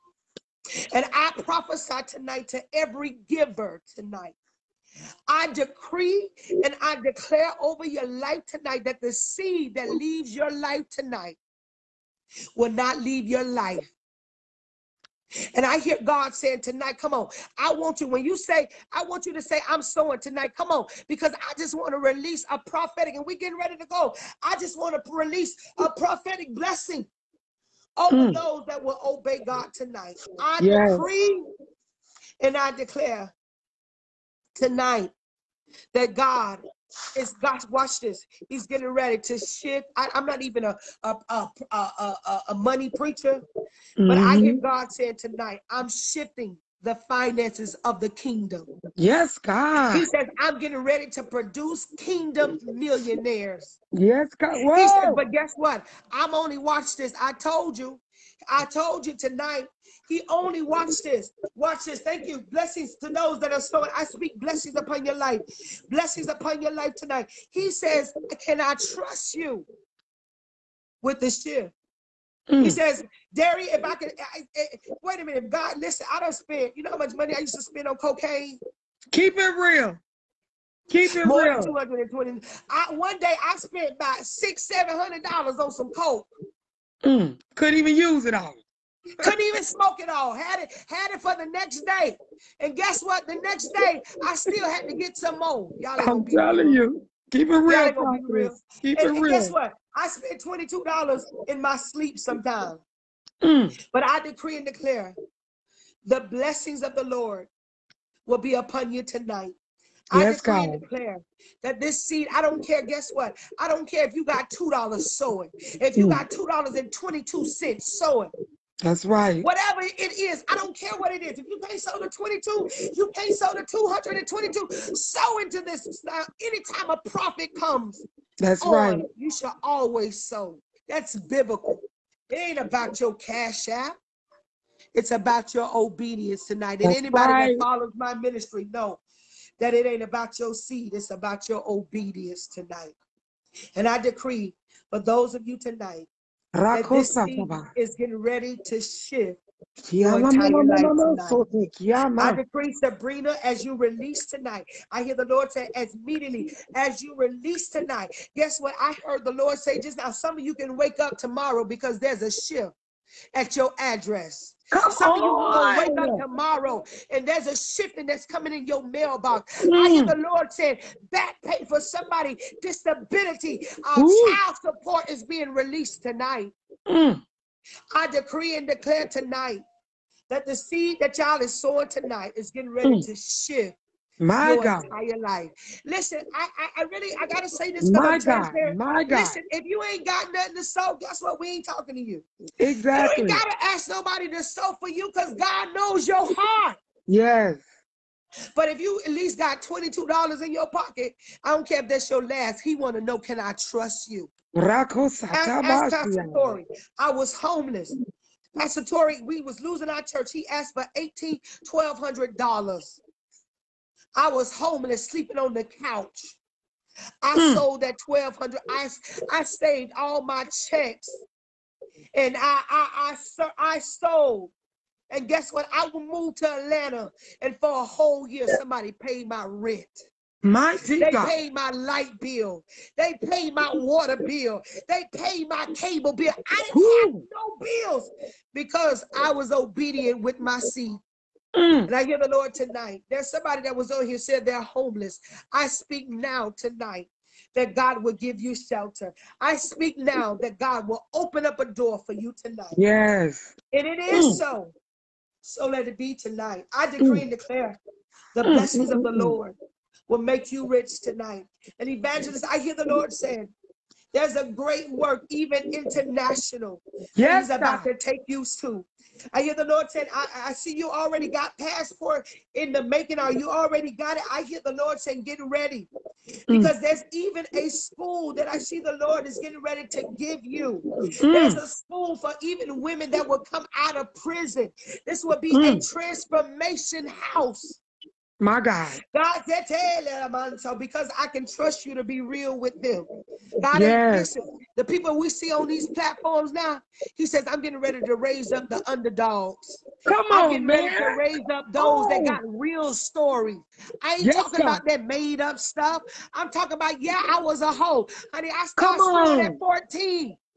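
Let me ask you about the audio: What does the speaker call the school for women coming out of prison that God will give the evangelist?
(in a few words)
transformation house.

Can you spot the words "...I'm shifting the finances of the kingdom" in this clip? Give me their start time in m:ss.
0:45.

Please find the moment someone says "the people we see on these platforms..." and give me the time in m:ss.
4:54.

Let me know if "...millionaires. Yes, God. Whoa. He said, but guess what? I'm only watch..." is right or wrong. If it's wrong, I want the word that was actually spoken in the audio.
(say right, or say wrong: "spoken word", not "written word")
right.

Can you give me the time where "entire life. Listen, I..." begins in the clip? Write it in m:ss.
3:04.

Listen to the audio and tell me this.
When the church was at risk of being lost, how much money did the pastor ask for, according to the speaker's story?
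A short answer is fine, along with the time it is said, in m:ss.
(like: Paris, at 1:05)
$1,800, at 3:30.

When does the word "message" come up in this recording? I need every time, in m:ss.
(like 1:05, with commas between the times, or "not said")
not said.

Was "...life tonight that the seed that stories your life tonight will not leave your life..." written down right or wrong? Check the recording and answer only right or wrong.
wrong.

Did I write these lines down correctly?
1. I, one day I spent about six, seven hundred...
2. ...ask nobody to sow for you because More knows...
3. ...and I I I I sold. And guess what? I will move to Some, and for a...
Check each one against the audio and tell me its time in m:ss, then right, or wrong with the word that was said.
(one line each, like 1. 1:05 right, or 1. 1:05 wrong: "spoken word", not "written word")
1. 1:22 right
2. 3:13 wrong: "God", not "More"
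3. 3:42 wrong: "Atlanta", not "Some".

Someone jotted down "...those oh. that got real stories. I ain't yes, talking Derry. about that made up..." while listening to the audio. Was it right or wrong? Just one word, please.
wrong.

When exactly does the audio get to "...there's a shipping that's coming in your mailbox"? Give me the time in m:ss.
2:47.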